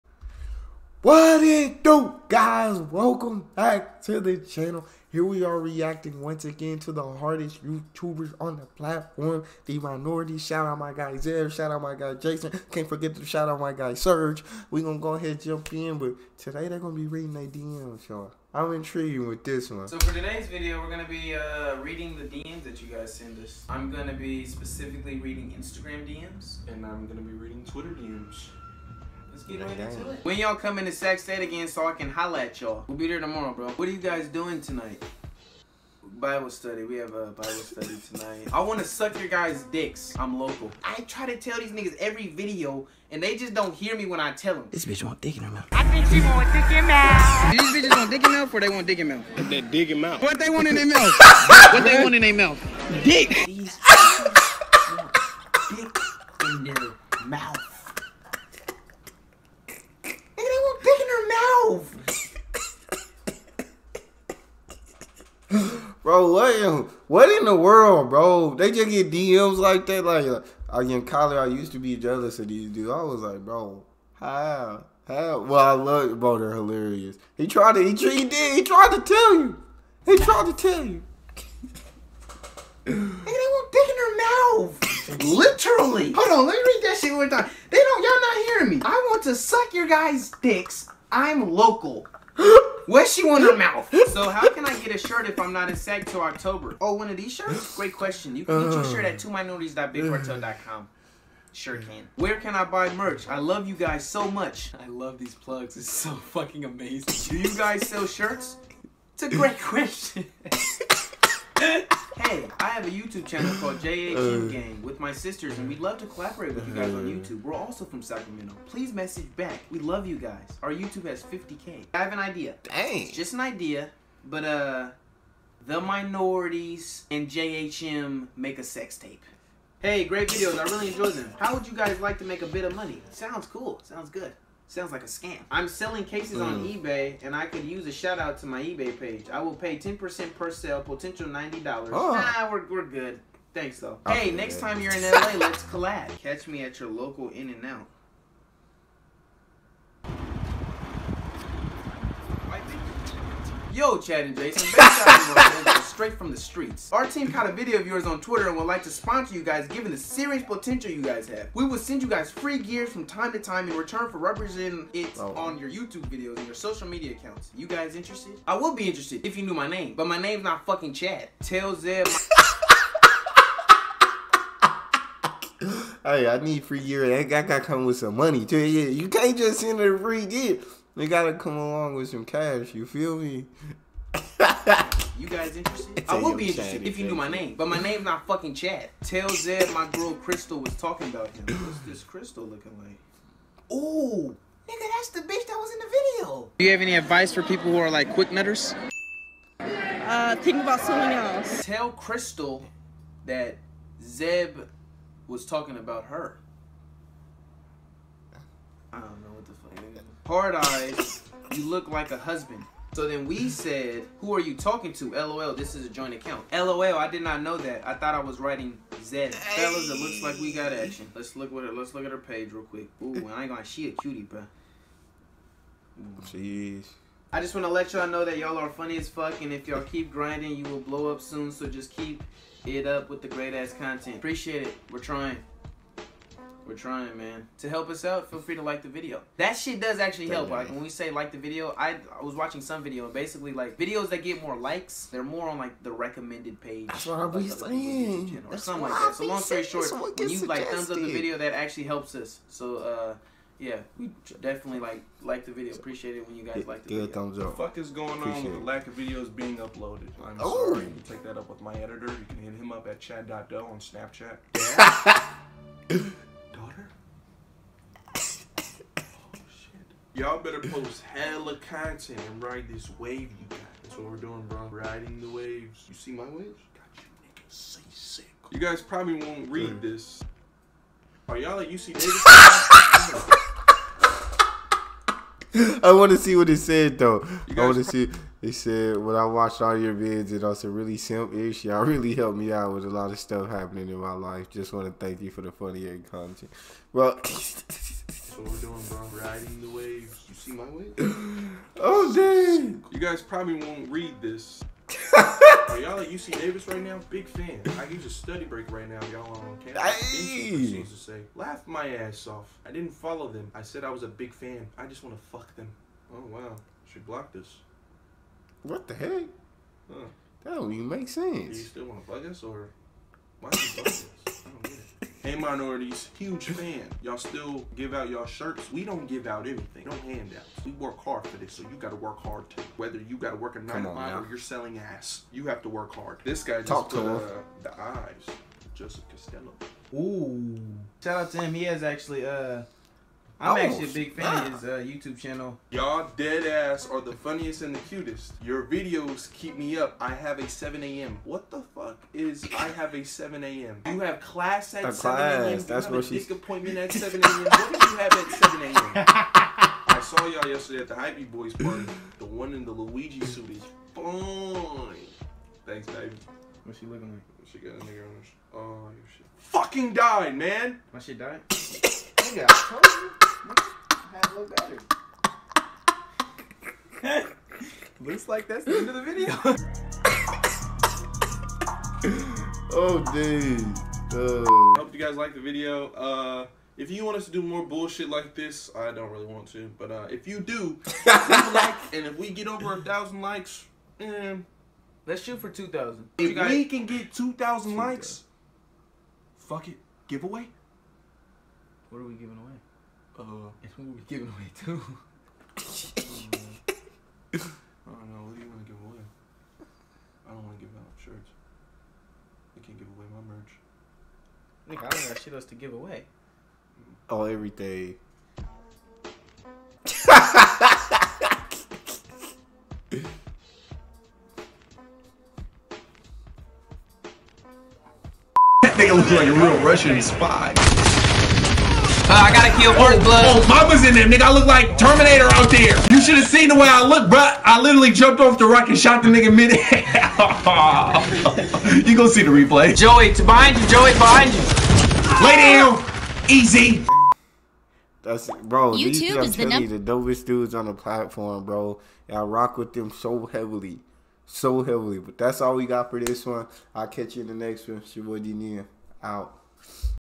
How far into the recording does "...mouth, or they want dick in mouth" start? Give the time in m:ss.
0:48.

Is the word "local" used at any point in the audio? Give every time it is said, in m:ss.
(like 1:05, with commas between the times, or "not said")
0:40, 1:31, 2:26.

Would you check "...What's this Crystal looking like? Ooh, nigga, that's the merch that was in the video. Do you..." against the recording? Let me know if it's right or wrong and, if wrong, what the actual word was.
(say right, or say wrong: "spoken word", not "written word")
wrong: "bitch", not "merch".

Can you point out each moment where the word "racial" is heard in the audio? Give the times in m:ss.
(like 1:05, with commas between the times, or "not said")
not said.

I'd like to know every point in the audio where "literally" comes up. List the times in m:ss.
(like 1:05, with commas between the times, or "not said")
1:25, 7:17.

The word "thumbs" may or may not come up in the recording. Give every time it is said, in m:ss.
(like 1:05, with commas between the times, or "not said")
4:10, 4:17.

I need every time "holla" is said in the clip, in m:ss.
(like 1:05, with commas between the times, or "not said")
0:32.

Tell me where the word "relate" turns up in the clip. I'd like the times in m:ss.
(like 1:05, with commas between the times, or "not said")
not said.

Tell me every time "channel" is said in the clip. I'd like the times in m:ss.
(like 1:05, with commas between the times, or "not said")
0:04, 1:53, 5:45.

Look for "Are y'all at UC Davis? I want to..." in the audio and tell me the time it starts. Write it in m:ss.
4:41.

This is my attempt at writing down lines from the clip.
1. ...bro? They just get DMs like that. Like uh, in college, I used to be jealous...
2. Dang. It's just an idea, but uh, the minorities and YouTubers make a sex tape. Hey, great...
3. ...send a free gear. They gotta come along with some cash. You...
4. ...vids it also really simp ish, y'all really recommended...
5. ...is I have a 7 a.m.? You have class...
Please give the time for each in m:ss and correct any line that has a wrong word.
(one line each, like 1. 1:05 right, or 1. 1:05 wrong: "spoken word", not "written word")
1. 1:08 right
2. 2:02 wrong: "JHM", not "YouTubers"
3. 2:59 right
4. 4:49 wrong: "helped", not "recommended"
5. 5:52 right.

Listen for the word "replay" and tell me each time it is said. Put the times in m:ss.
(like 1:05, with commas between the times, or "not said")
7:22.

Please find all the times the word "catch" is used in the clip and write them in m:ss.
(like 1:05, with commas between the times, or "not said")
2:26, 7:36.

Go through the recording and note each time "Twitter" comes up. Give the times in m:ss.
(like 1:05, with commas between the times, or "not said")
0:27, 2:38.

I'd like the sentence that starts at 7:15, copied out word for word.
You should have seen the way I look, bro.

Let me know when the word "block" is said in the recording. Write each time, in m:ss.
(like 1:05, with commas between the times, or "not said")
5:17.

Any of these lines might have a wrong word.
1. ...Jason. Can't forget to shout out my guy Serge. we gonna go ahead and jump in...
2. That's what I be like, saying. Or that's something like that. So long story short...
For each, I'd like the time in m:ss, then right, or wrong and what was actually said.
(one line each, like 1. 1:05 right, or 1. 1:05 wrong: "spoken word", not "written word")
1. 0:12 right
2. 4:06 right.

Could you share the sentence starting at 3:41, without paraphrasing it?
Let's look what it let's look at her page real quick.